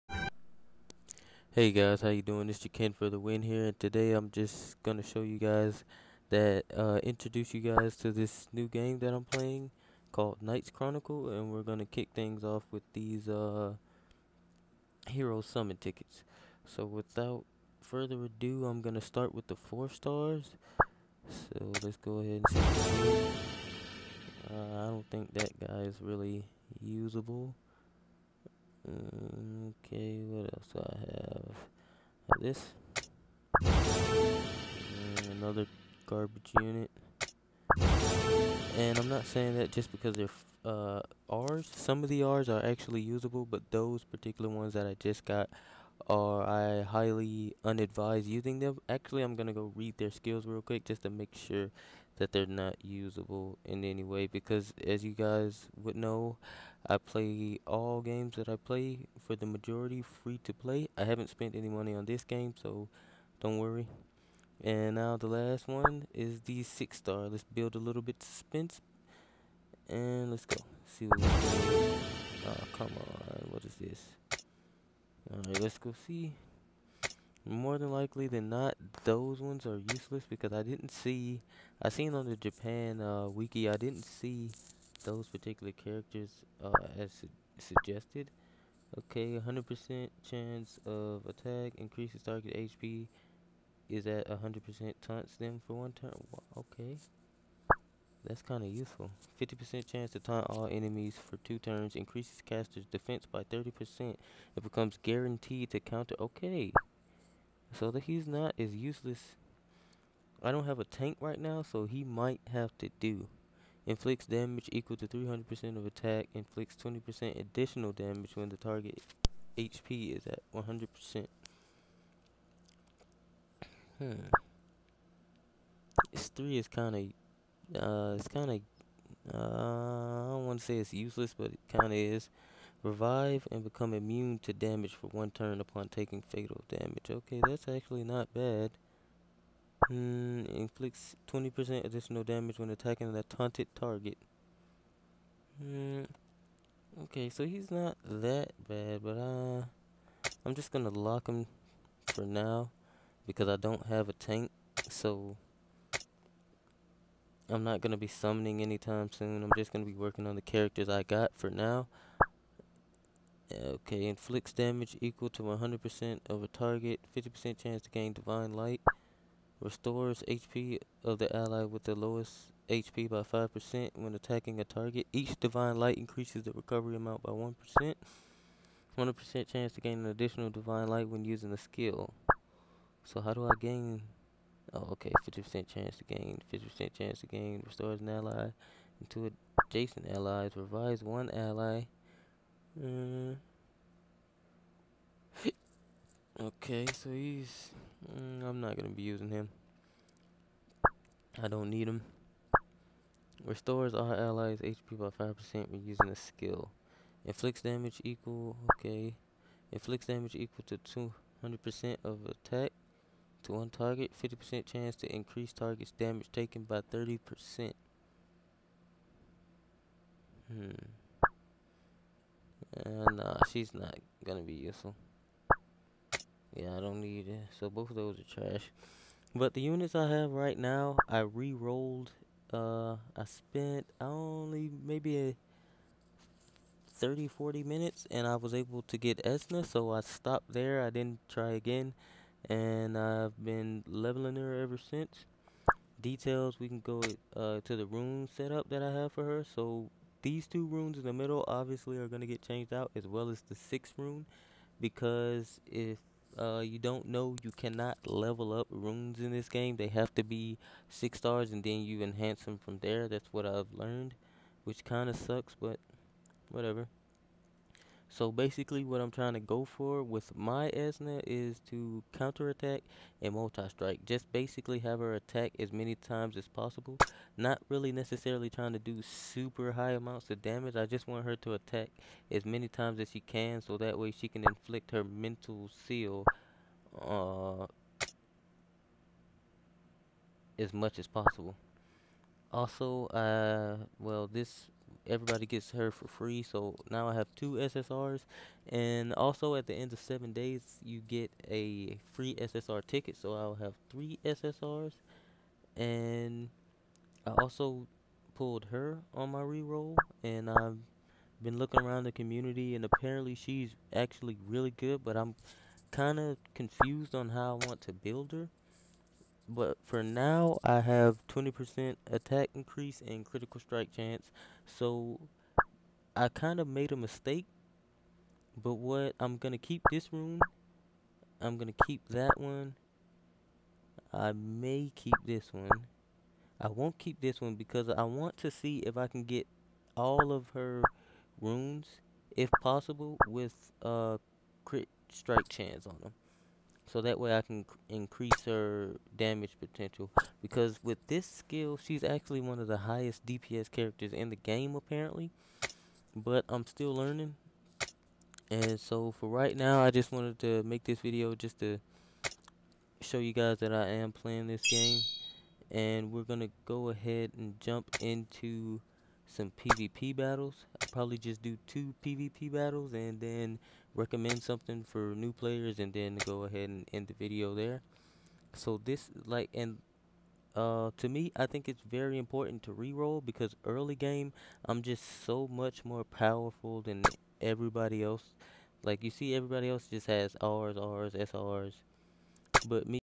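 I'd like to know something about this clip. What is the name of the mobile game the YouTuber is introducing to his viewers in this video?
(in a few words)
Knights Chronicle.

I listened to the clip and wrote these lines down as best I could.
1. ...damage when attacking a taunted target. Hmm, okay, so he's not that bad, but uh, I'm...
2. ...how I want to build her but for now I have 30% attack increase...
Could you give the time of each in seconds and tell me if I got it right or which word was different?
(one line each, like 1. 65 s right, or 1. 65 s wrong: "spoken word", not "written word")
1. 142 s right
2. 317 s wrong: "20", not "30".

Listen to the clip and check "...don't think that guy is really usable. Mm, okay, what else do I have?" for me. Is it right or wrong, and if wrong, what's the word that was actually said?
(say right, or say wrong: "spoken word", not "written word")
right.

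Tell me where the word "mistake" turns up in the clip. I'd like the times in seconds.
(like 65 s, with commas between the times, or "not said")
326 s.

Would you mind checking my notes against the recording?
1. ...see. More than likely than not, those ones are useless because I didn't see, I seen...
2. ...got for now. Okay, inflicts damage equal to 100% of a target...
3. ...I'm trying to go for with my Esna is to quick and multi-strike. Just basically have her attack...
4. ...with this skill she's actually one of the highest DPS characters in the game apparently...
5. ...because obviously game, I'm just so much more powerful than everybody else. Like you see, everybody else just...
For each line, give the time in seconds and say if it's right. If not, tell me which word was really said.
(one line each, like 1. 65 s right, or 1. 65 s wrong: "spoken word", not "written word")
1. 76 s right
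2. 161 s right
3. 268 s wrong: "counterattack", not "quick"
4. 350 s right
5. 383 s wrong: "early", not "obviously".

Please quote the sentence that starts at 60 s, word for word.
I haven't spent any money on this game, so don't worry.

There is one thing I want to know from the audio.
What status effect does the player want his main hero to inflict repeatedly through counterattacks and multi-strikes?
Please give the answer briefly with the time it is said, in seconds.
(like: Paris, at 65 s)
mental seal, at 285 s.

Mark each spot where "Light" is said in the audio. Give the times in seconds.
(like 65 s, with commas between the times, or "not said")
168 s, 175 s, 180 s.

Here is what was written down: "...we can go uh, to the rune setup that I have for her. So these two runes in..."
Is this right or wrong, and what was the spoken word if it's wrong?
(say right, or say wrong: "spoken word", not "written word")
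right.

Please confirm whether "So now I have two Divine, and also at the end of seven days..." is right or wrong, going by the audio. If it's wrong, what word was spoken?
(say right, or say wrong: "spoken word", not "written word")
wrong: "SSRs", not "Divine".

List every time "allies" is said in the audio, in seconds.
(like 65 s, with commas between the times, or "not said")
190 s, 204 s.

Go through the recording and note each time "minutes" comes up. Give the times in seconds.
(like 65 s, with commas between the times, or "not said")
237 s.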